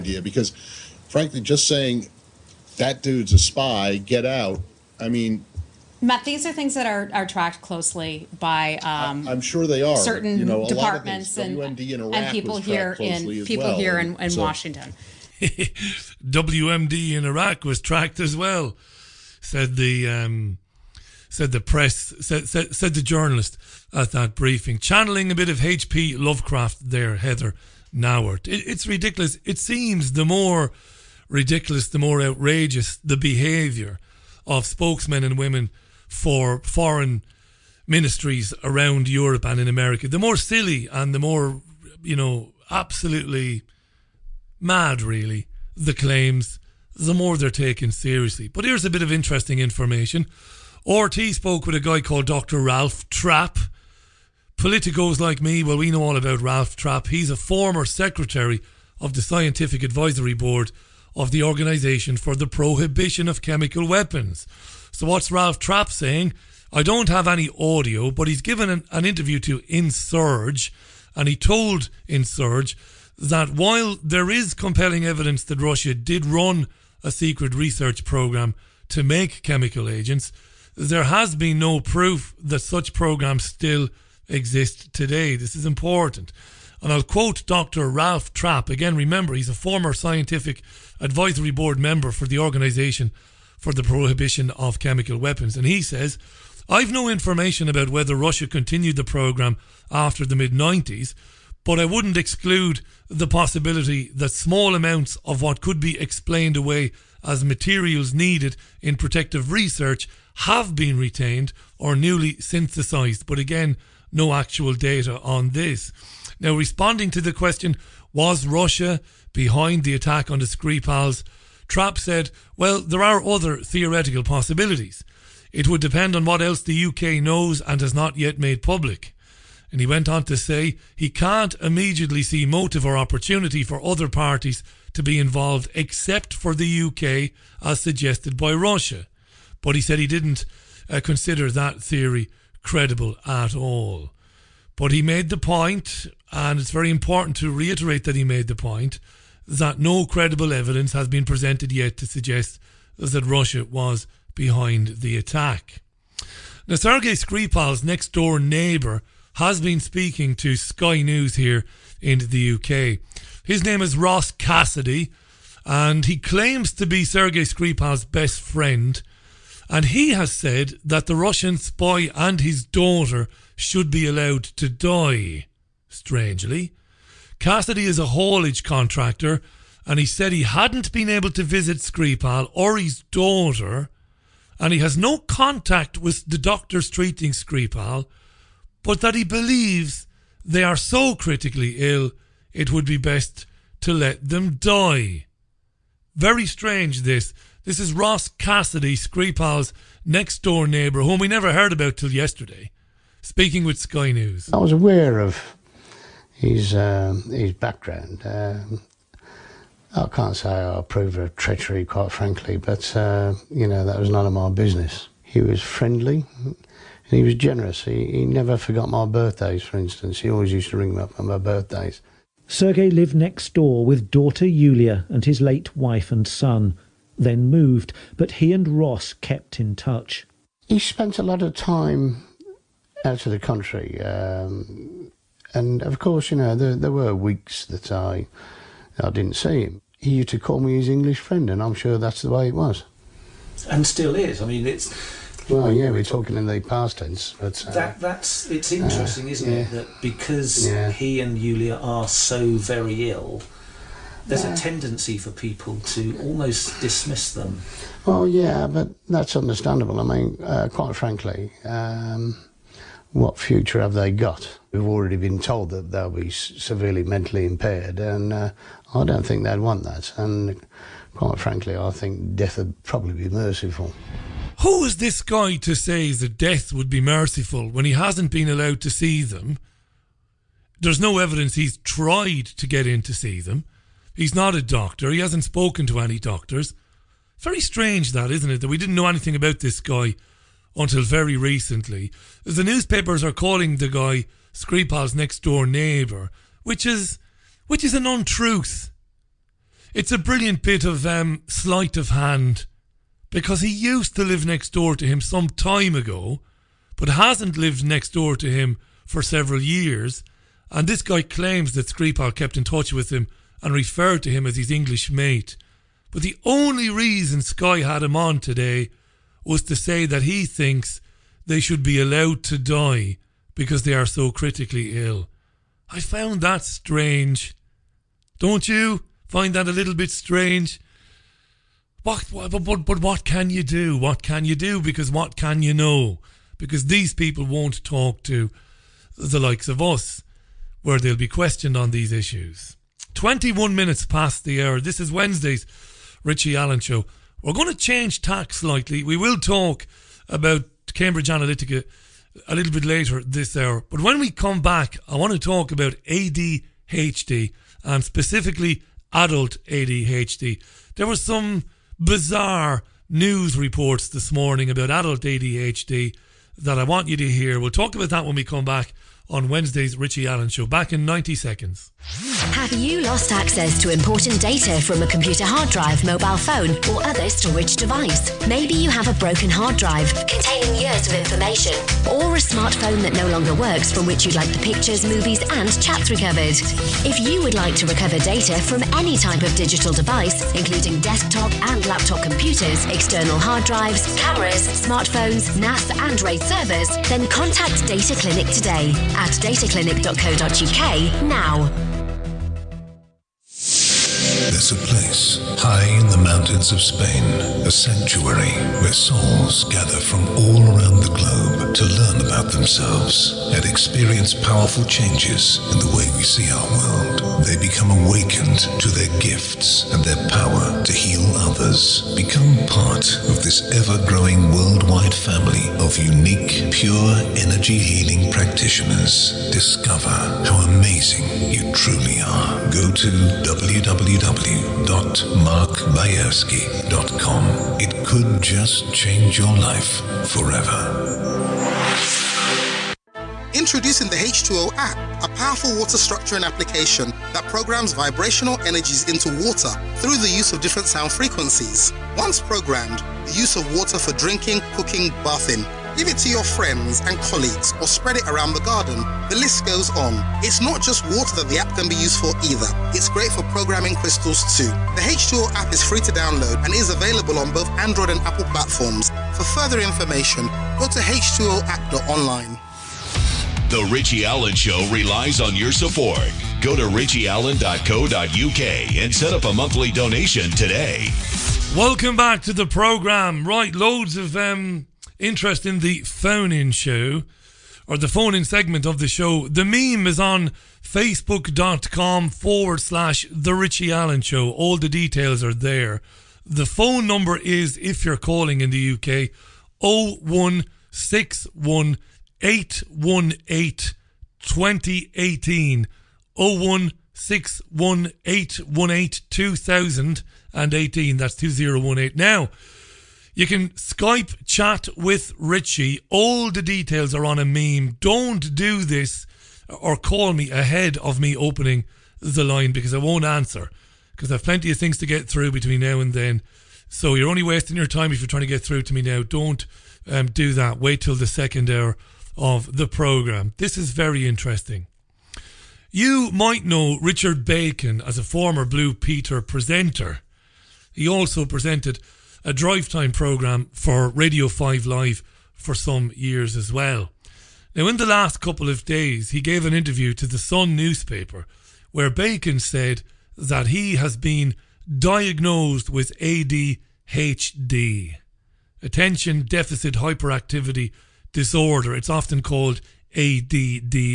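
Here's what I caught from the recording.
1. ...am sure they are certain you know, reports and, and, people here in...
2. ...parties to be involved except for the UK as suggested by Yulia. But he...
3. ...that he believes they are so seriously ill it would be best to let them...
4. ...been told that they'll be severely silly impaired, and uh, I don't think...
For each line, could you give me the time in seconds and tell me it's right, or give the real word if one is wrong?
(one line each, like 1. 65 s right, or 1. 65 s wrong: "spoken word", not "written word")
1. 9 s wrong: "departments", not "reports"
2. 134 s wrong: "Russia", not "Yulia"
3. 189 s wrong: "critically", not "seriously"
4. 265 s wrong: "mentally", not "silly".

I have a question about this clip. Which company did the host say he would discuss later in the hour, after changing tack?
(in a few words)
Cambridge Analytica.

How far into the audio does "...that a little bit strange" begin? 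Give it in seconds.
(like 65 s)
329 s.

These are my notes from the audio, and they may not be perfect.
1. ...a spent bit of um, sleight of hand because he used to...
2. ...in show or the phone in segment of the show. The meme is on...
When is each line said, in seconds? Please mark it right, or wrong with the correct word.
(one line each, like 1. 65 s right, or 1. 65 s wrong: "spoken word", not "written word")
1. 300 s wrong: "brilliant", not "spent"
2. 486 s right.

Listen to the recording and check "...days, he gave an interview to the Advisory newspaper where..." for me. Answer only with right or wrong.
wrong.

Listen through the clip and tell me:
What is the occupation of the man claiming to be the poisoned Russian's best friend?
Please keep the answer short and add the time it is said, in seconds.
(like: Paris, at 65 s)
haulage contractor, at 178 s.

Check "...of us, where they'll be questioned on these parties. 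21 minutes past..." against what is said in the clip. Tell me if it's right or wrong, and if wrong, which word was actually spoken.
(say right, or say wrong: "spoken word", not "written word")
wrong: "issues", not "parties".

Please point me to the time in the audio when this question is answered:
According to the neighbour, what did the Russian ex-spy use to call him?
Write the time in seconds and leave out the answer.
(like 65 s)
240 s.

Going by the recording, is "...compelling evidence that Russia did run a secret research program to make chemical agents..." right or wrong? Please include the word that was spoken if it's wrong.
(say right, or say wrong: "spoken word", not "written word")
right.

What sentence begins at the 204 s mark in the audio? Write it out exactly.
I was aware of his, um, his background.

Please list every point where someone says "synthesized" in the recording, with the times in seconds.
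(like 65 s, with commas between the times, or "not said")
112 s.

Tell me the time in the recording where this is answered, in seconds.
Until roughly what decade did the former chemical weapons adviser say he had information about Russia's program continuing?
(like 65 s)
100 s.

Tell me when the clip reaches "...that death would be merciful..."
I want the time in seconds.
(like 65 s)
276 s.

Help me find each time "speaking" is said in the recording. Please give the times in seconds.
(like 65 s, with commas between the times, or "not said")
159 s, 203 s.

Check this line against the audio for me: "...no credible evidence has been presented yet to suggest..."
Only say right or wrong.
right.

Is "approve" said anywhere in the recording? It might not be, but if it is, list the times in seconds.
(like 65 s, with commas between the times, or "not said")
210 s.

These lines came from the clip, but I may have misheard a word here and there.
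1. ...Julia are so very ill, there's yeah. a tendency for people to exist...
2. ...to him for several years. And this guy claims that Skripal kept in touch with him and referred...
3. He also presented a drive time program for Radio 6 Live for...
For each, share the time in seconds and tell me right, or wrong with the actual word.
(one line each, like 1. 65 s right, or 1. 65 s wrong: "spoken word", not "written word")
1. 251 s wrong: "almost", not "exist"
2. 308 s right
3. 540 s wrong: "5", not "6".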